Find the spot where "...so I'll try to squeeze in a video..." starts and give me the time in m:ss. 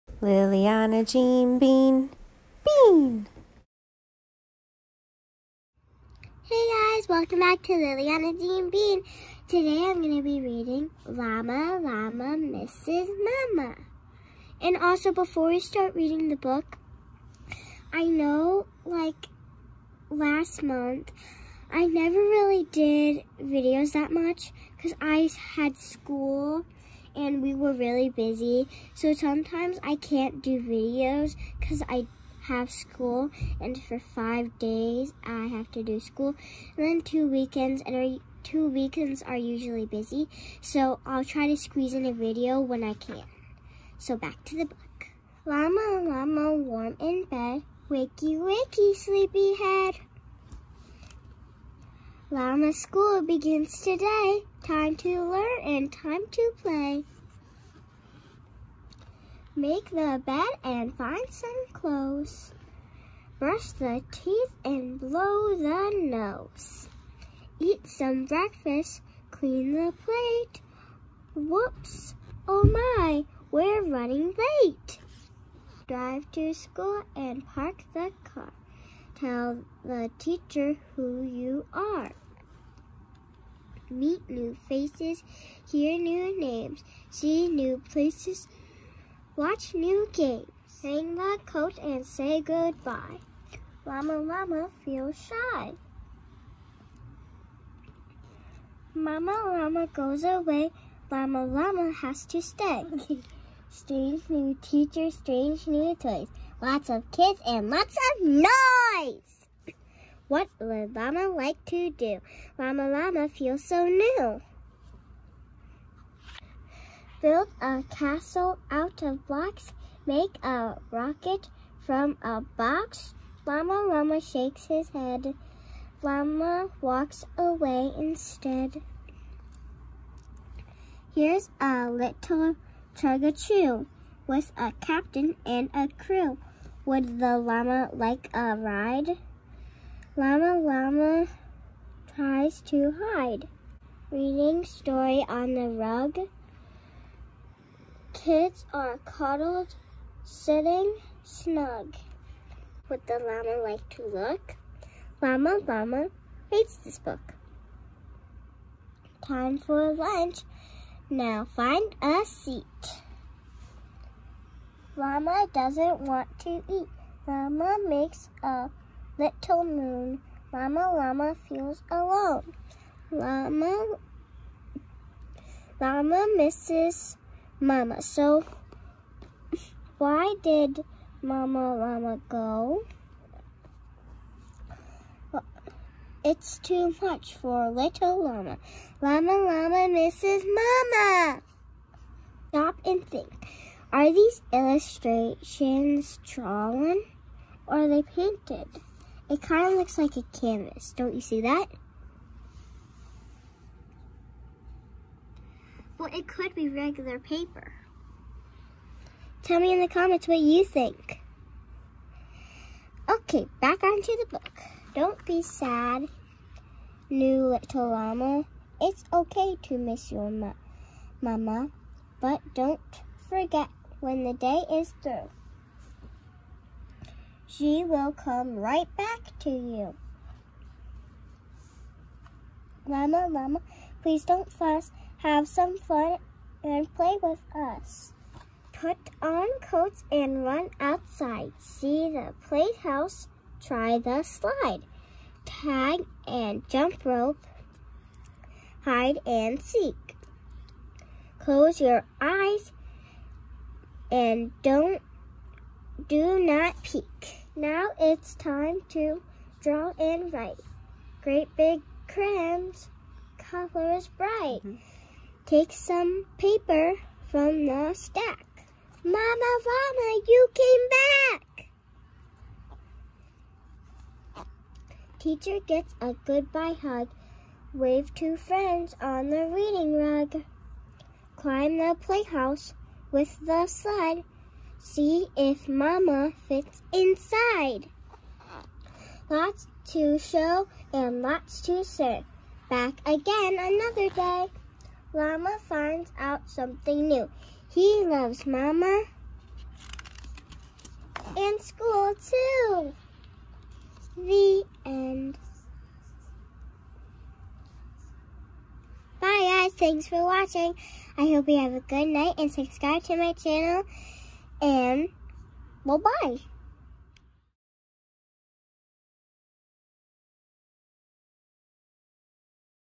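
0:40.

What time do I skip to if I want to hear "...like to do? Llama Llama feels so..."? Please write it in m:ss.
1:51.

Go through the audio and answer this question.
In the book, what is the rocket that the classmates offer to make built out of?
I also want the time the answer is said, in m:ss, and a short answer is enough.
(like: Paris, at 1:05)
a box, at 2:02.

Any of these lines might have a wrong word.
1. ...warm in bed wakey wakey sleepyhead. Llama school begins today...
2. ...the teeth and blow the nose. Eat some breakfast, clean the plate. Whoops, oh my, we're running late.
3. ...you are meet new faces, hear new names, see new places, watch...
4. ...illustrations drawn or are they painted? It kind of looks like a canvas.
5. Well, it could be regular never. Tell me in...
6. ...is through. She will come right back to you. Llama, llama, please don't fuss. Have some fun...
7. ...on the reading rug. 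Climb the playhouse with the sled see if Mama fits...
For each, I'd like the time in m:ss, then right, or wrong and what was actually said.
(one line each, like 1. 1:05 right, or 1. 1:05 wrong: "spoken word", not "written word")
1. 0:46 right
2. 1:03 right
3. 1:21 right
4. 3:14 right
5. 3:25 wrong: "paper", not "never"
6. 3:44 right
7. 4:39 right.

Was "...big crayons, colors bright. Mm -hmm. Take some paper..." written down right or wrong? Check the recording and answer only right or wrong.
right.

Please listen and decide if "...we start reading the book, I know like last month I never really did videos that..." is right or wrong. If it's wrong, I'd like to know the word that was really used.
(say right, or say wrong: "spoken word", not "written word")
right.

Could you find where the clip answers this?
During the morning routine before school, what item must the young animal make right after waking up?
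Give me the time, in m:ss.
0:59.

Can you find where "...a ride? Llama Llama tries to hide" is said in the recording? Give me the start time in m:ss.
2:18.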